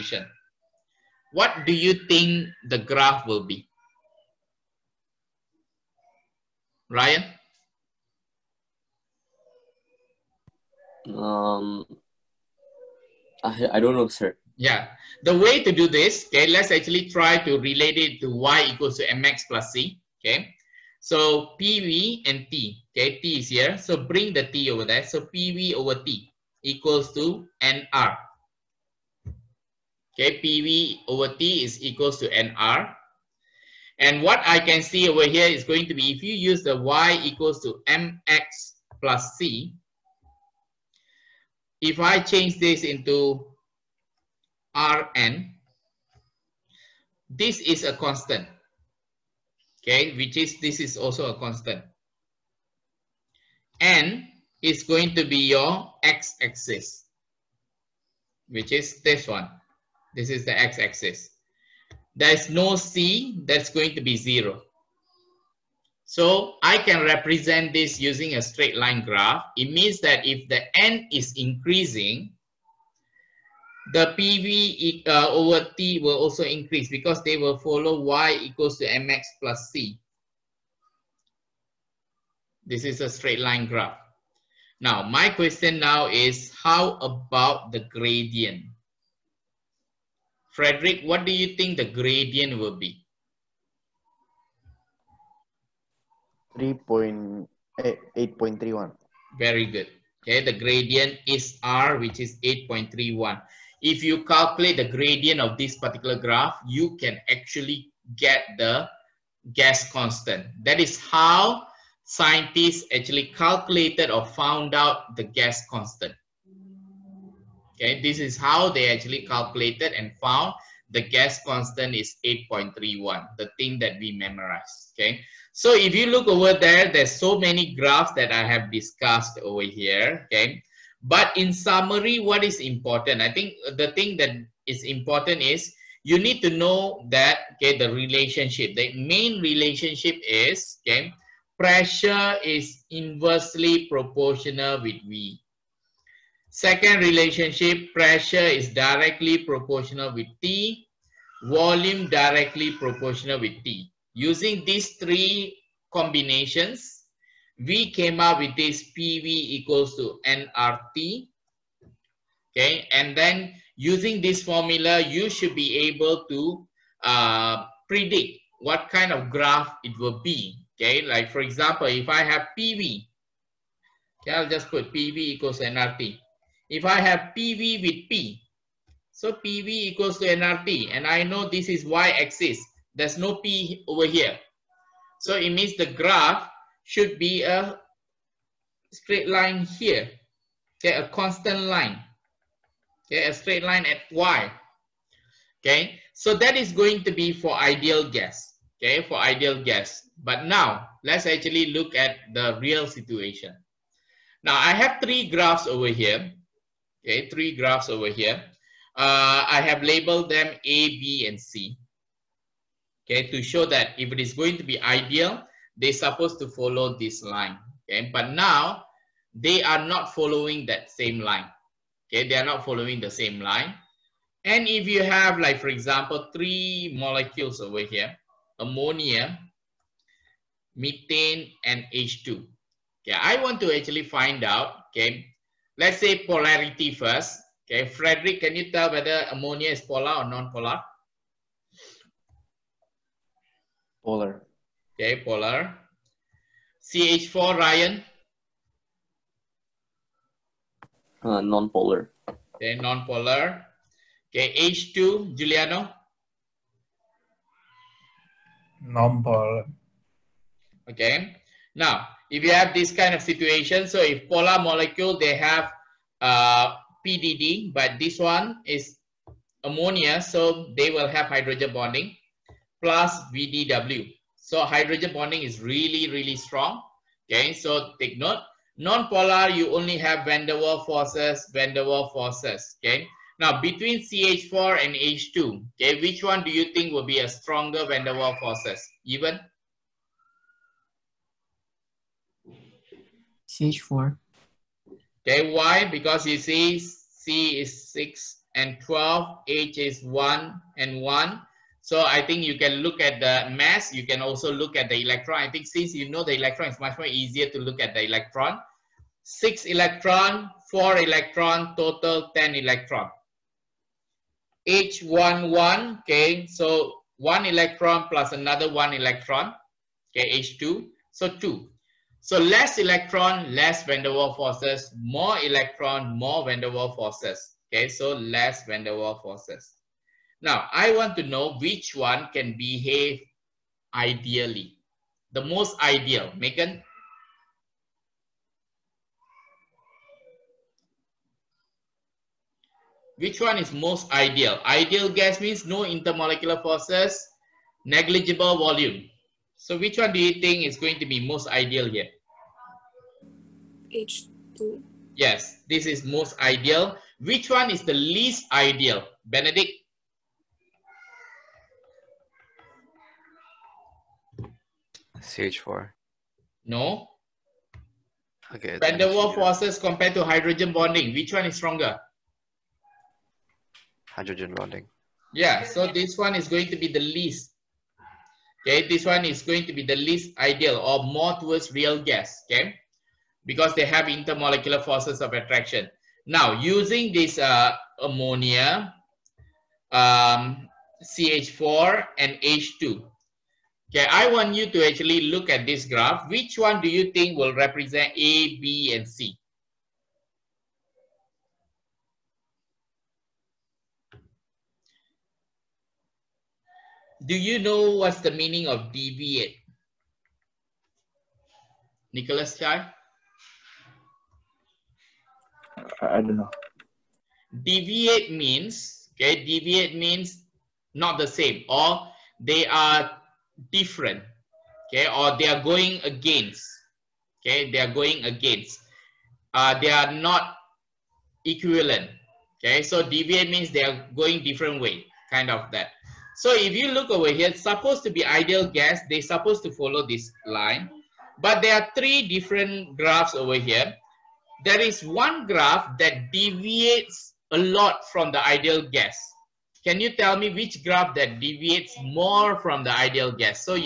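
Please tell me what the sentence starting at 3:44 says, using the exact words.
And if you have like, for example, three molecules over here, ammonia, methane, and H2.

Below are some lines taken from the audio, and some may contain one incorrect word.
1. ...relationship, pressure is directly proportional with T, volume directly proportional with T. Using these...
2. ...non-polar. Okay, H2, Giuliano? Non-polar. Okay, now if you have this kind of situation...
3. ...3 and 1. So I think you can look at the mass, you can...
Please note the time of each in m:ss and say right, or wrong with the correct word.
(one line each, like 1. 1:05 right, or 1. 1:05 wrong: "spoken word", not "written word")
1. 2:26 right
2. 4:12 right
3. 5:00 wrong: "1", not "3".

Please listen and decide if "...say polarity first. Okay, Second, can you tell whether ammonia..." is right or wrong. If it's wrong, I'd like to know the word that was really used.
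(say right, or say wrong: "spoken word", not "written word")
wrong: "Frederick", not "Second".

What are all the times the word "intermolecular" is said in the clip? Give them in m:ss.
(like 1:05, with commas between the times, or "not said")
5:45, 6:24.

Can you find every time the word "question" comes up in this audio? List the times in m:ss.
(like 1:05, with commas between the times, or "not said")
1:25.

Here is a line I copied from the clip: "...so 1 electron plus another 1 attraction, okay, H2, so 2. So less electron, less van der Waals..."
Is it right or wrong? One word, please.
wrong.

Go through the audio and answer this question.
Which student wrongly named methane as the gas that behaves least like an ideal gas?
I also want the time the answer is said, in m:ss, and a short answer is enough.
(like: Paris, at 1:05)
Benedict, at 5:59.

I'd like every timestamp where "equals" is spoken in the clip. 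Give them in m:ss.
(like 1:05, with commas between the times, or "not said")
0:18, 0:26, 0:31, 0:37, 1:18, 2:39, 2:55, 2:59.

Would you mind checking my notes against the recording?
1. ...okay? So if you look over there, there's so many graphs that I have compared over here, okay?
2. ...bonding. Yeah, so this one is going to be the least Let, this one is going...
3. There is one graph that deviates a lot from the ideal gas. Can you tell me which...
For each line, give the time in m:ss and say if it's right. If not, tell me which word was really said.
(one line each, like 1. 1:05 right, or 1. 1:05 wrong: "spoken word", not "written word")
1. 2:04 wrong: "discussed", not "compared"
2. 6:14 wrong: "Okay", not "Let"
3. 7:24 right.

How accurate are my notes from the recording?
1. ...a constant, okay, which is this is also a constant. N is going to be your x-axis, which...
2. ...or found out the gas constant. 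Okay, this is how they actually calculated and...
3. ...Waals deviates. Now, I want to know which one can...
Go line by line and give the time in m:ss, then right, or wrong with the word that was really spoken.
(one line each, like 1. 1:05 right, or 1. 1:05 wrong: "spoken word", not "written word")
1. 0:47 right
2. 1:54 right
3. 5:28 wrong: "forces", not "deviates".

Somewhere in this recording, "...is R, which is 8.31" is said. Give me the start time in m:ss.
1:41.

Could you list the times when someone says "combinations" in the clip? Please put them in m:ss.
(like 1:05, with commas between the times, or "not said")
2:35.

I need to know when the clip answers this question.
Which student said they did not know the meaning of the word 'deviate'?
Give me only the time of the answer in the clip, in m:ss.
6:52.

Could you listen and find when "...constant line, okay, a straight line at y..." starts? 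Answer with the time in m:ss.
3:11.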